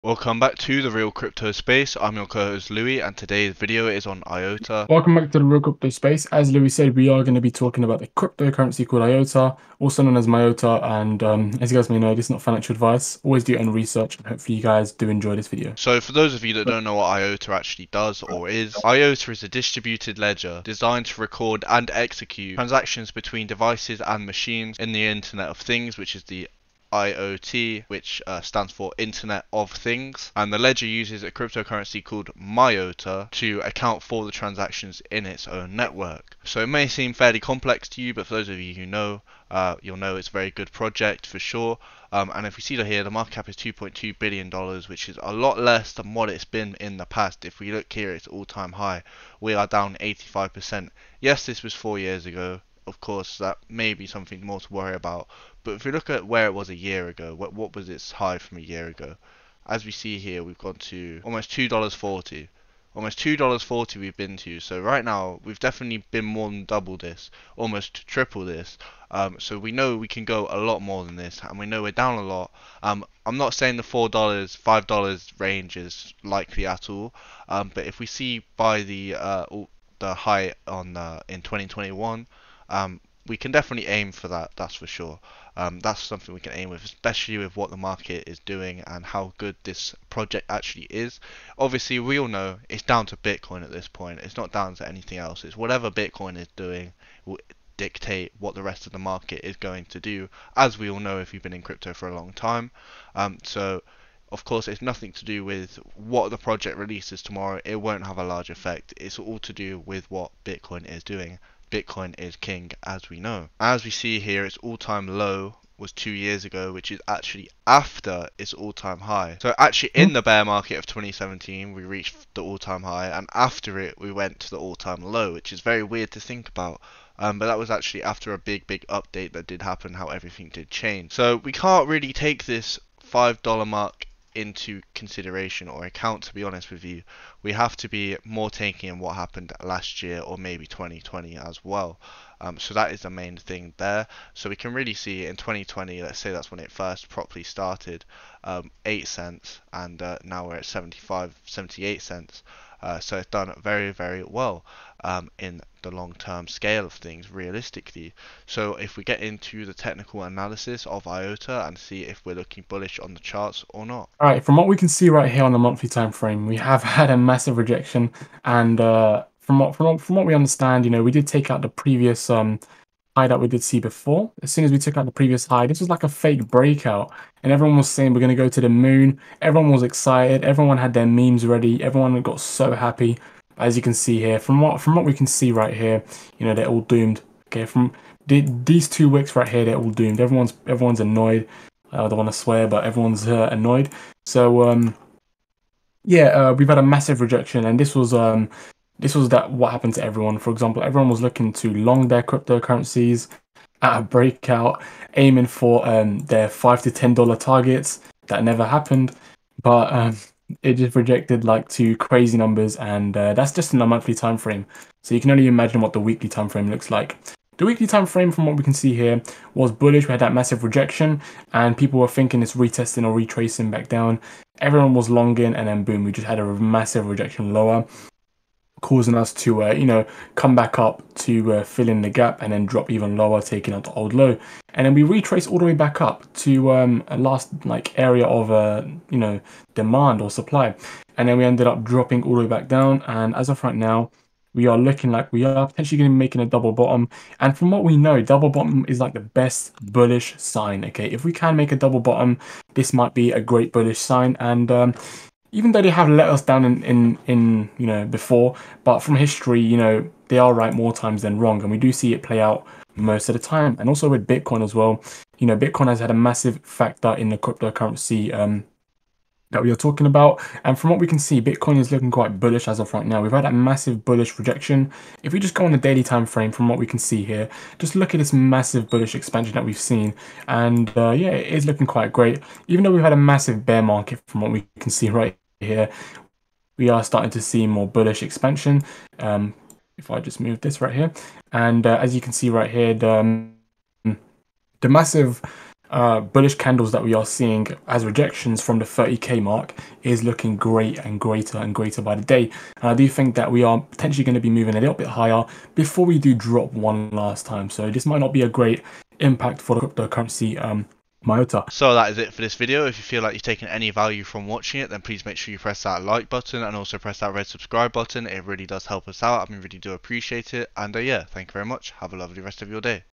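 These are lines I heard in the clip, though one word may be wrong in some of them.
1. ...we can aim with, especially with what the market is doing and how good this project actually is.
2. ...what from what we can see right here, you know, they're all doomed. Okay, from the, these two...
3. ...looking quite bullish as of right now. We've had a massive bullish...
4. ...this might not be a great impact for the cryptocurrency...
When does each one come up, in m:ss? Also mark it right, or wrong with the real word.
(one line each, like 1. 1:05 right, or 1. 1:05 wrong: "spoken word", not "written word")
1. 1:26 right
2. 3:04 right
3. 4:31 right
4. 5:07 right.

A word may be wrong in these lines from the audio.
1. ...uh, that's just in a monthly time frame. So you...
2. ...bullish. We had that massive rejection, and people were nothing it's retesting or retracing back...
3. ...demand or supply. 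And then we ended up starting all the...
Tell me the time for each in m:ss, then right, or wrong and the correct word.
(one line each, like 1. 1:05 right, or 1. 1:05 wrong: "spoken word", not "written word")
1. 3:33 right
2. 3:39 wrong: "thinking", not "nothing"
3. 3:59 wrong: "dropping", not "starting".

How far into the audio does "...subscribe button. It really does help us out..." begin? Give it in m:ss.
5:17.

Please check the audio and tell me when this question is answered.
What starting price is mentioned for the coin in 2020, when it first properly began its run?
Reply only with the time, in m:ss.
2:28.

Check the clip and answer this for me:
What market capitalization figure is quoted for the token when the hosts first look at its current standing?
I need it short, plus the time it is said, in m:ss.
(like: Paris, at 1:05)
2.2 billion dollars, at 0:43.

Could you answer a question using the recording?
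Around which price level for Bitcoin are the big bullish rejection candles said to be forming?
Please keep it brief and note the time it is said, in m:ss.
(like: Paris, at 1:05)
30k, at 4:58.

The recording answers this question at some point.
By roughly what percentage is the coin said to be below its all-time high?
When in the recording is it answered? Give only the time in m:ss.
0:50.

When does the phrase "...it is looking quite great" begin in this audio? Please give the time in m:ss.
4:41.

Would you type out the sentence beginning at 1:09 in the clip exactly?
Um, so we know we can go a lot more than this, and we know we're down a lot.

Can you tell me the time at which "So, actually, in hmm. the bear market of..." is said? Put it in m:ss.
1:59.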